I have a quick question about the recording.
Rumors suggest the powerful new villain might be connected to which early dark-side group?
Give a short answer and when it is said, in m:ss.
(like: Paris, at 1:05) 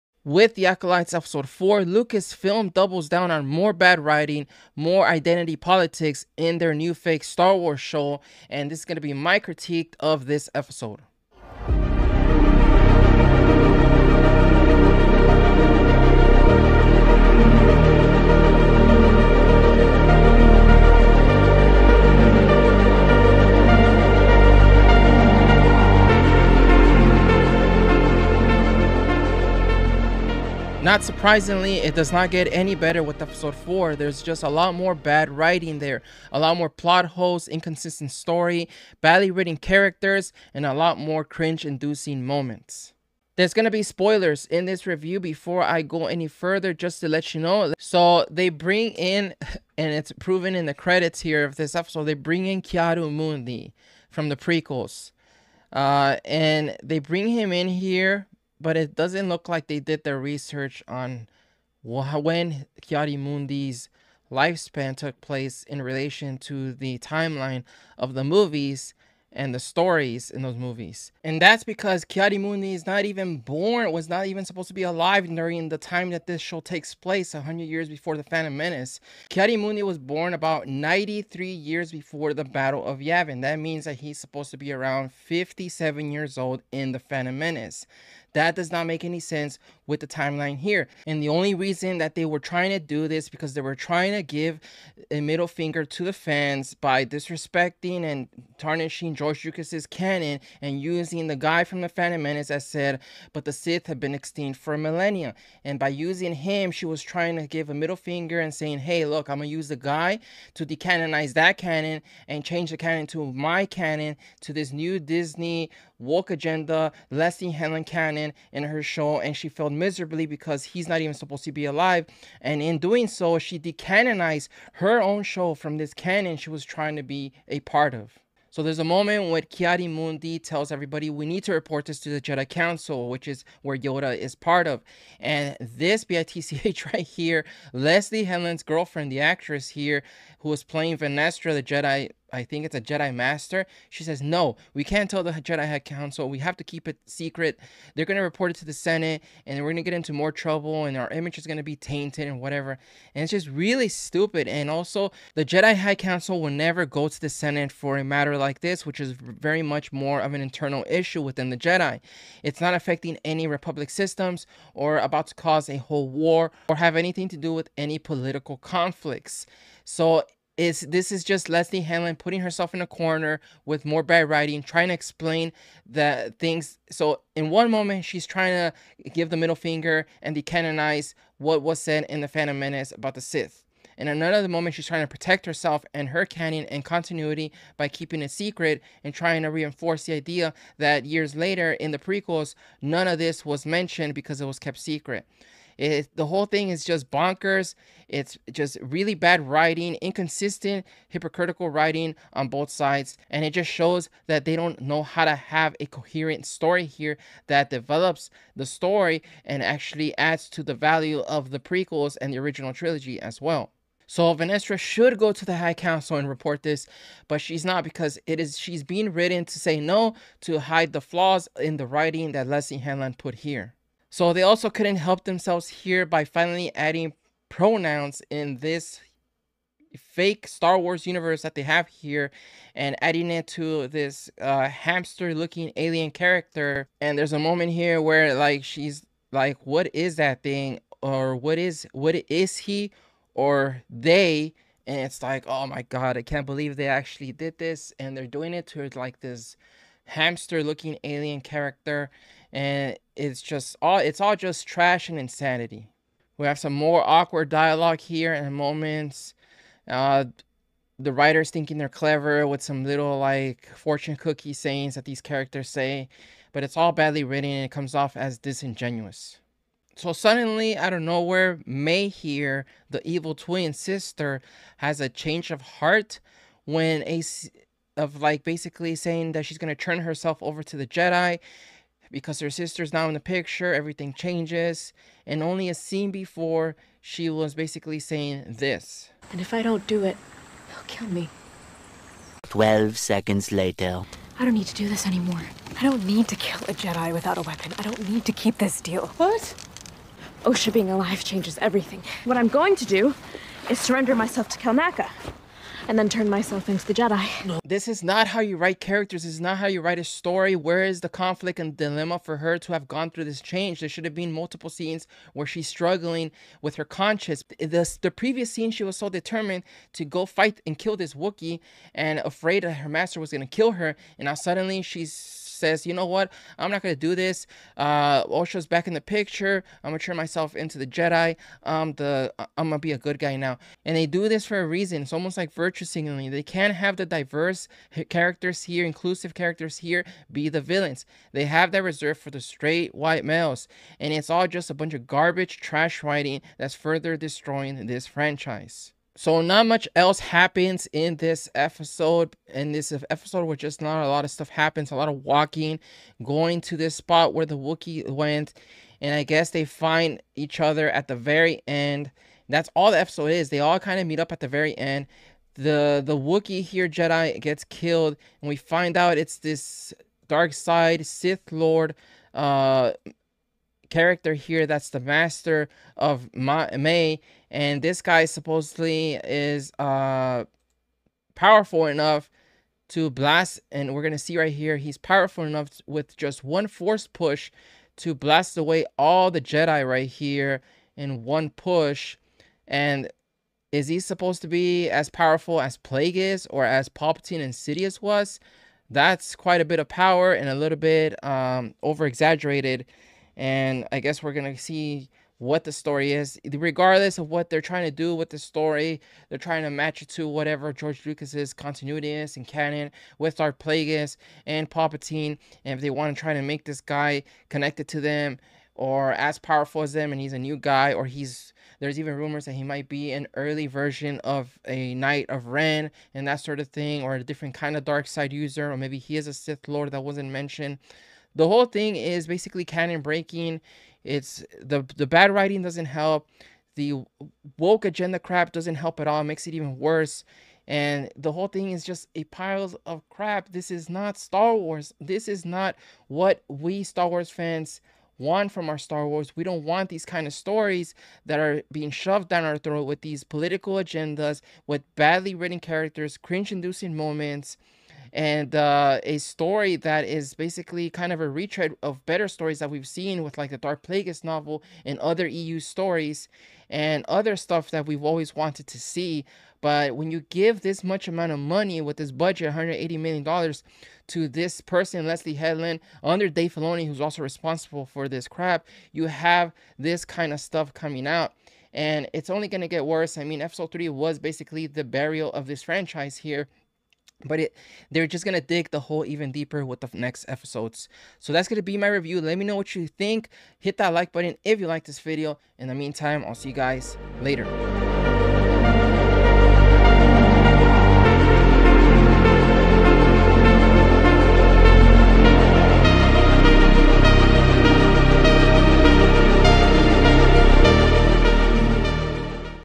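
Knight of Ren, at 7:04.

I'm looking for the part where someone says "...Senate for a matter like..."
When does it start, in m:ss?
2:37.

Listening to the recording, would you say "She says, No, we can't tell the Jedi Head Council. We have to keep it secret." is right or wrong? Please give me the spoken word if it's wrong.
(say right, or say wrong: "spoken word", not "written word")
right.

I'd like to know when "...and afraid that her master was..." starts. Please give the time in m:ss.
5:21.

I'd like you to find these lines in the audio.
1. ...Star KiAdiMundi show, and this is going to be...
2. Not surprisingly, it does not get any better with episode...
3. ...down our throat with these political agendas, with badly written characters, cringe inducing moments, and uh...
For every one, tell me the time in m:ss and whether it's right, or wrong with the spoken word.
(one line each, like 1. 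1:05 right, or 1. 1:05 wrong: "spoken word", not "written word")
1. 0:07 wrong: "Wars", not "KiAdiMundi"
2. 0:30 right
3. 7:32 right.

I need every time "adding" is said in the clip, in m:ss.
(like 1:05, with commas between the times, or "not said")
3:46, 3:53.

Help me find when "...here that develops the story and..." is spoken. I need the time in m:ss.
3:26.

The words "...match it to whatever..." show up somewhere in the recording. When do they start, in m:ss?
6:49.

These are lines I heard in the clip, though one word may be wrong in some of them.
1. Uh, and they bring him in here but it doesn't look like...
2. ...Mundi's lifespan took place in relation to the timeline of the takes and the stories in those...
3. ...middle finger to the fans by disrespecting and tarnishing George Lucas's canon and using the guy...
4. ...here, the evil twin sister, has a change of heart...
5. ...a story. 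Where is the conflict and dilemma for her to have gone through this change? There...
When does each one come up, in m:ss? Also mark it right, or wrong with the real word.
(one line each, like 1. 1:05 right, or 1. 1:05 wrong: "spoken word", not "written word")
1. 0:55 right
2. 1:02 wrong: "movies", not "takes"
3. 1:35 right
4. 4:32 right
5. 5:09 right.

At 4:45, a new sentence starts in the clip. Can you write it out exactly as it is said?
And only a scene before, she was basically saying this.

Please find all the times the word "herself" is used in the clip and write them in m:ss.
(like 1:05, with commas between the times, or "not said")
2:52, 3:05, 4:39.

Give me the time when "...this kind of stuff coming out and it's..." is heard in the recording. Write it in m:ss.
7:59.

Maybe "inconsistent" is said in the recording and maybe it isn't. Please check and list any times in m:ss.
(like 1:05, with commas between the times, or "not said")
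0:37, 3:20.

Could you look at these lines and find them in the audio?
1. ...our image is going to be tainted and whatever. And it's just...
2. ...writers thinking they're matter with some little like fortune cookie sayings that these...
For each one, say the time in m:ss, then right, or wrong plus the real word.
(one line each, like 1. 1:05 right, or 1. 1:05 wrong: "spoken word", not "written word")
1. 2:30 right
2. 4:21 wrong: "clever", not "matter".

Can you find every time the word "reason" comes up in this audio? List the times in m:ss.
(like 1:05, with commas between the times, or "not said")
1:31, 5:34.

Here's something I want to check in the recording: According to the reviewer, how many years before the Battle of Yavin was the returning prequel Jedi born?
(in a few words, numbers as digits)
93.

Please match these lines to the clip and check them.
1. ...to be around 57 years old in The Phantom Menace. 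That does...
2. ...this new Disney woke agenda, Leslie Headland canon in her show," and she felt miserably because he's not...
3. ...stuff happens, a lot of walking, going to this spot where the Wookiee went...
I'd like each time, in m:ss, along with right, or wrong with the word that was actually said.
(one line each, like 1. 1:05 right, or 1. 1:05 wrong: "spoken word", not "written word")
1. 1:24 right
2. 1:54 right
3. 5:54 right.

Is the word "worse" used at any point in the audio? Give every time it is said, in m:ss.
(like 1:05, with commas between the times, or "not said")
7:19, 8:02.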